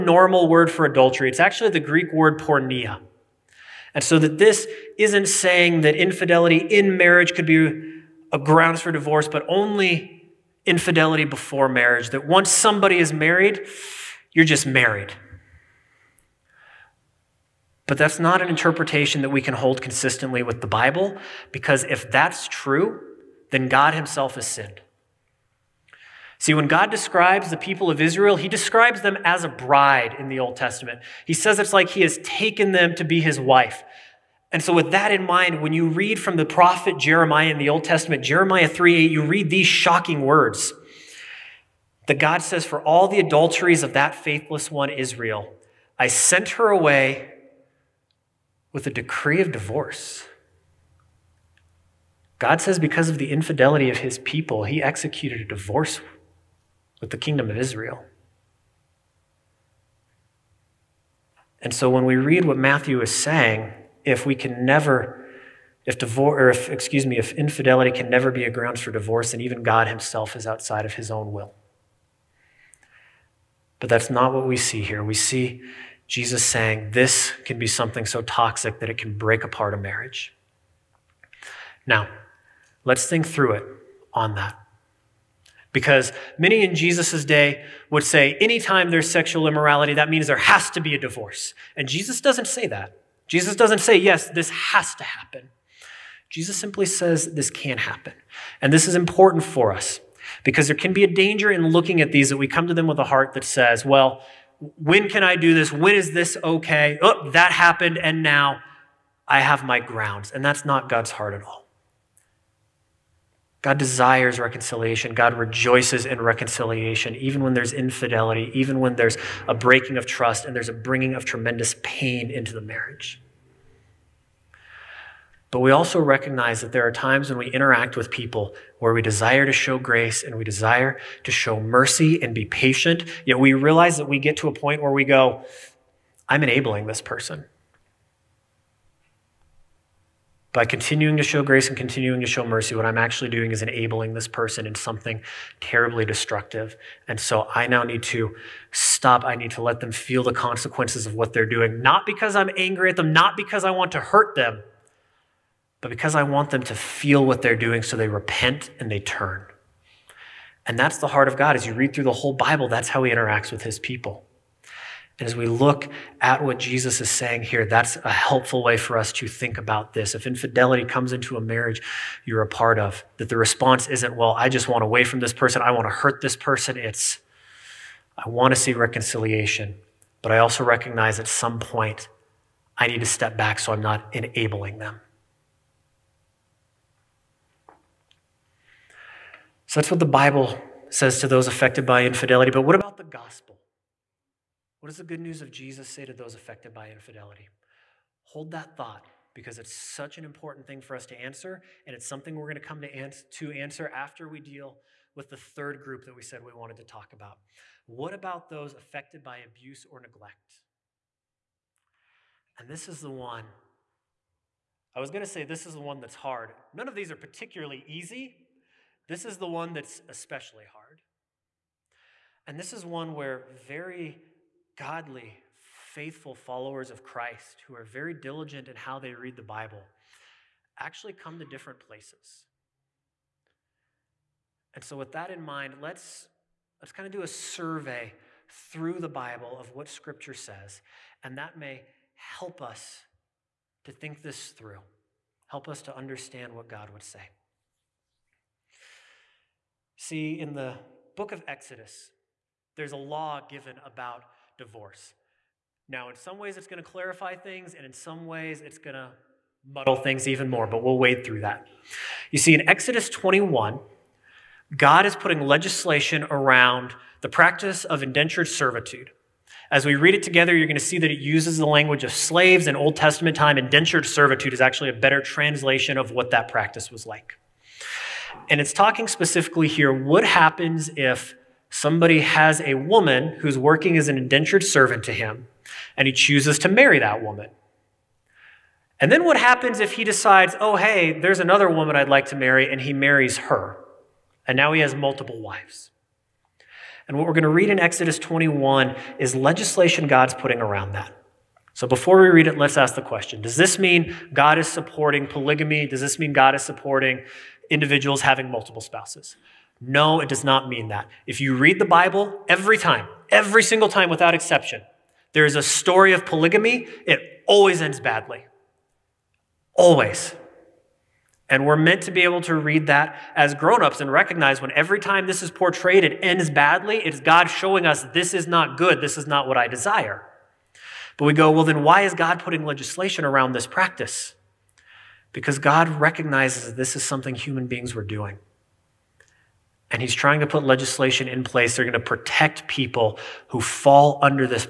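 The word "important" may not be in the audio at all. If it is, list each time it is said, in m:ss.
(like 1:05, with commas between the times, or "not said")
1:38, 3:20.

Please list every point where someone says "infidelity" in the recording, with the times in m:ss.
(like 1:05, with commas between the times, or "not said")
0:05, 0:10, 0:53, 1:07, 1:57, 2:50, 3:12, 3:16.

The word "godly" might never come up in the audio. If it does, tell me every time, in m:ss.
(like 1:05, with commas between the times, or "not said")
3:44.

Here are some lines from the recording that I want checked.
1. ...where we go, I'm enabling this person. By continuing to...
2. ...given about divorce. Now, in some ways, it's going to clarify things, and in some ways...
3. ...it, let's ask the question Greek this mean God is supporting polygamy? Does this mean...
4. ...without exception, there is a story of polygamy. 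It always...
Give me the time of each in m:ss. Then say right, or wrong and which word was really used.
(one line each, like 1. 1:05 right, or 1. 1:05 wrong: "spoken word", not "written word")
1. 2:14 right
2. 4:13 right
3. 5:02 wrong: "Does", not "Greek"
4. 5:14 right.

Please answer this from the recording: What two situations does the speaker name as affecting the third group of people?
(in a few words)
abuse or neglect.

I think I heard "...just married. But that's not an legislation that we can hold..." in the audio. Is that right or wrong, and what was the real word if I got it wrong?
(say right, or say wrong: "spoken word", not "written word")
wrong: "interpretation", not "legislation".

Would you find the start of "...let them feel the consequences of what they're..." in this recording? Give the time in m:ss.
2:29.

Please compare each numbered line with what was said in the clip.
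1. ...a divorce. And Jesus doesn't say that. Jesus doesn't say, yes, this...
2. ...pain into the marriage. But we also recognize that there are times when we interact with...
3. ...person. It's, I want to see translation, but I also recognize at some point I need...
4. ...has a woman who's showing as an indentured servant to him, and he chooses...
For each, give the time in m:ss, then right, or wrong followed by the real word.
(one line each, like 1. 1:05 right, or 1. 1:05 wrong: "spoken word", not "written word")
1. 1:30 right
2. 2:01 right
3. 2:56 wrong: "reconciliation", not "translation"
4. 4:42 wrong: "working", not "showing".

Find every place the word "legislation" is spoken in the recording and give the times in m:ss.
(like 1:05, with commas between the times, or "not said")
4:25, 4:59, 5:32, 5:40.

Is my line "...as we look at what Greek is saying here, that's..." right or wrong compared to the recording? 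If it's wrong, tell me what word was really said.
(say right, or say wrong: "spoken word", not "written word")
wrong: "Jesus", not "Greek".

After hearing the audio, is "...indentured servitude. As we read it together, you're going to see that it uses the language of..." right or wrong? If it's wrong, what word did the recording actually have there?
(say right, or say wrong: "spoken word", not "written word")
right.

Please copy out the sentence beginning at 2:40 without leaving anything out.
And that's the heart of God.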